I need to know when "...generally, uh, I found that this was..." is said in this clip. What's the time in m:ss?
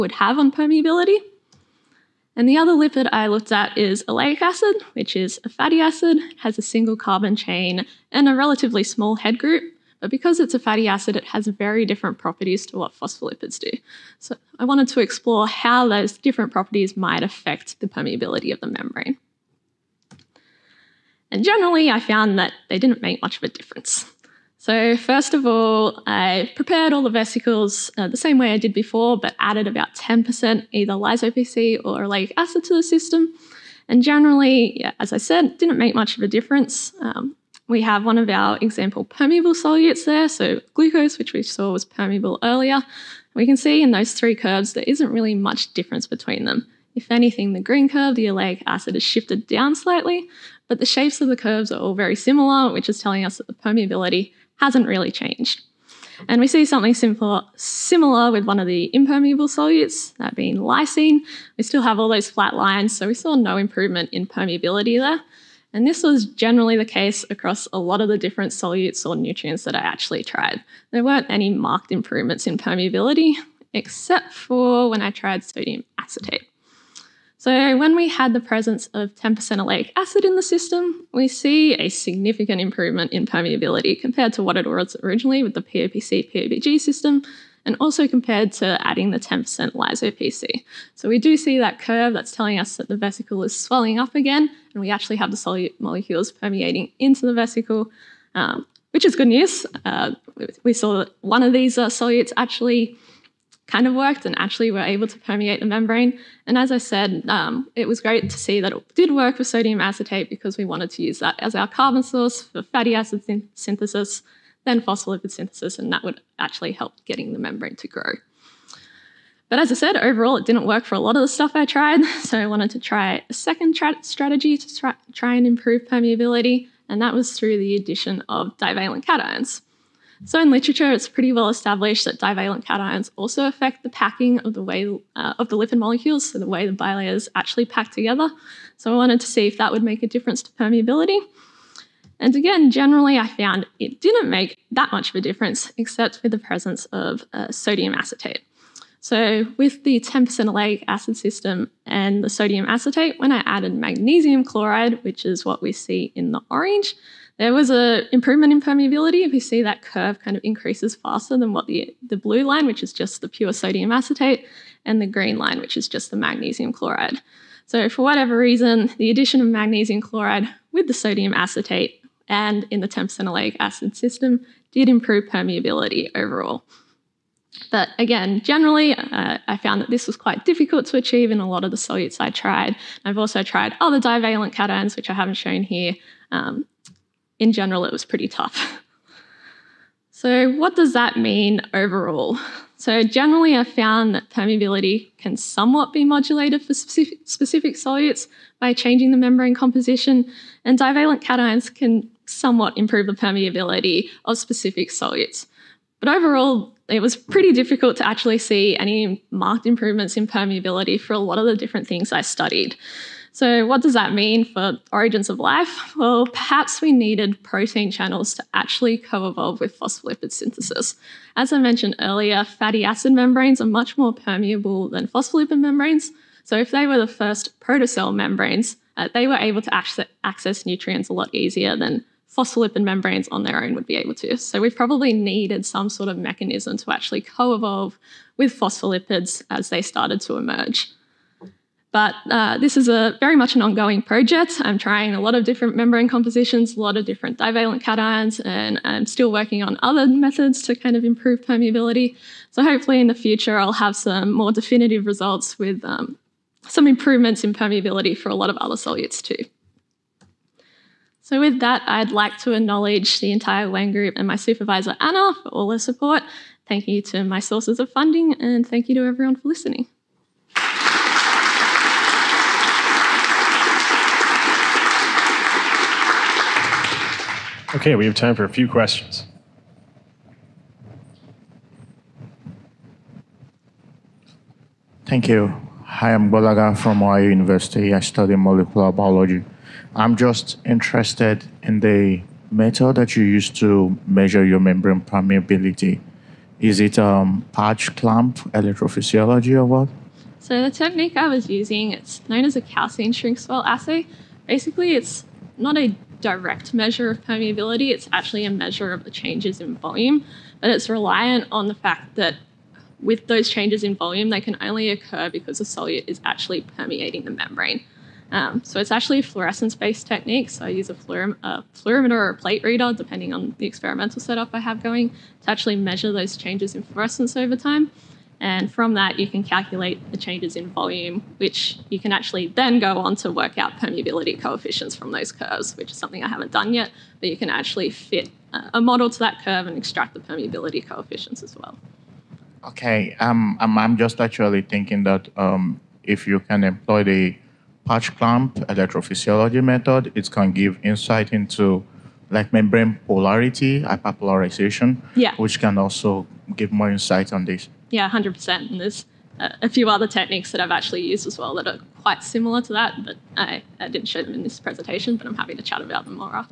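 2:58.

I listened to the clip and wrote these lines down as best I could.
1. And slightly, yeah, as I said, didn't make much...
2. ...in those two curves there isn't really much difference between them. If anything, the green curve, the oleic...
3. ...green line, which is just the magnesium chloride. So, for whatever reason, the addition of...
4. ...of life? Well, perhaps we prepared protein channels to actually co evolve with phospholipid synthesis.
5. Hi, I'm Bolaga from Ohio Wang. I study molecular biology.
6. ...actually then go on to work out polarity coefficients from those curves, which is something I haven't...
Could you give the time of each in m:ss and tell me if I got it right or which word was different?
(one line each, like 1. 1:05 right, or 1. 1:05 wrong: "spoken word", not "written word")
1. 0:33 wrong: "generally", not "slightly"
2. 0:43 wrong: "three", not "two"
3. 2:45 right
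4. 3:35 wrong: "needed", not "prepared"
5. 4:45 wrong: "University", not "Wang"
6. 5:32 wrong: "permeability", not "polarity".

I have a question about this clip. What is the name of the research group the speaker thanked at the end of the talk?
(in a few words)
Wang group.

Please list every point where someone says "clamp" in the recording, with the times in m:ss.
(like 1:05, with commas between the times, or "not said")
4:57, 5:48.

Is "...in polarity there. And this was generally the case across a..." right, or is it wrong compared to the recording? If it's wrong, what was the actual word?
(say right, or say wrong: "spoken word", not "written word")
wrong: "permeability", not "polarity".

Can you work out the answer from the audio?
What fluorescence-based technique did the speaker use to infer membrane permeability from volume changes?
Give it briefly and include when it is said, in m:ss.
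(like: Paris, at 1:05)
calcein shrink swell assay, at 5:02.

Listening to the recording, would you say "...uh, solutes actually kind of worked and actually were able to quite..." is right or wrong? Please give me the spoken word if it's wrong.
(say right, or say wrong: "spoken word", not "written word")
wrong: "permeate", not "quite".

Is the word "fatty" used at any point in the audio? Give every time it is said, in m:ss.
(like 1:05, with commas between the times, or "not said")
0:05, 0:10, 1:52, 3:42.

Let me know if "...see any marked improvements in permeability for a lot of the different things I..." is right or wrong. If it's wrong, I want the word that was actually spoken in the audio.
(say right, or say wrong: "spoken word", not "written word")
right.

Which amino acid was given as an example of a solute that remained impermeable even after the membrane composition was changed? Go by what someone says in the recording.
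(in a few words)
lysine.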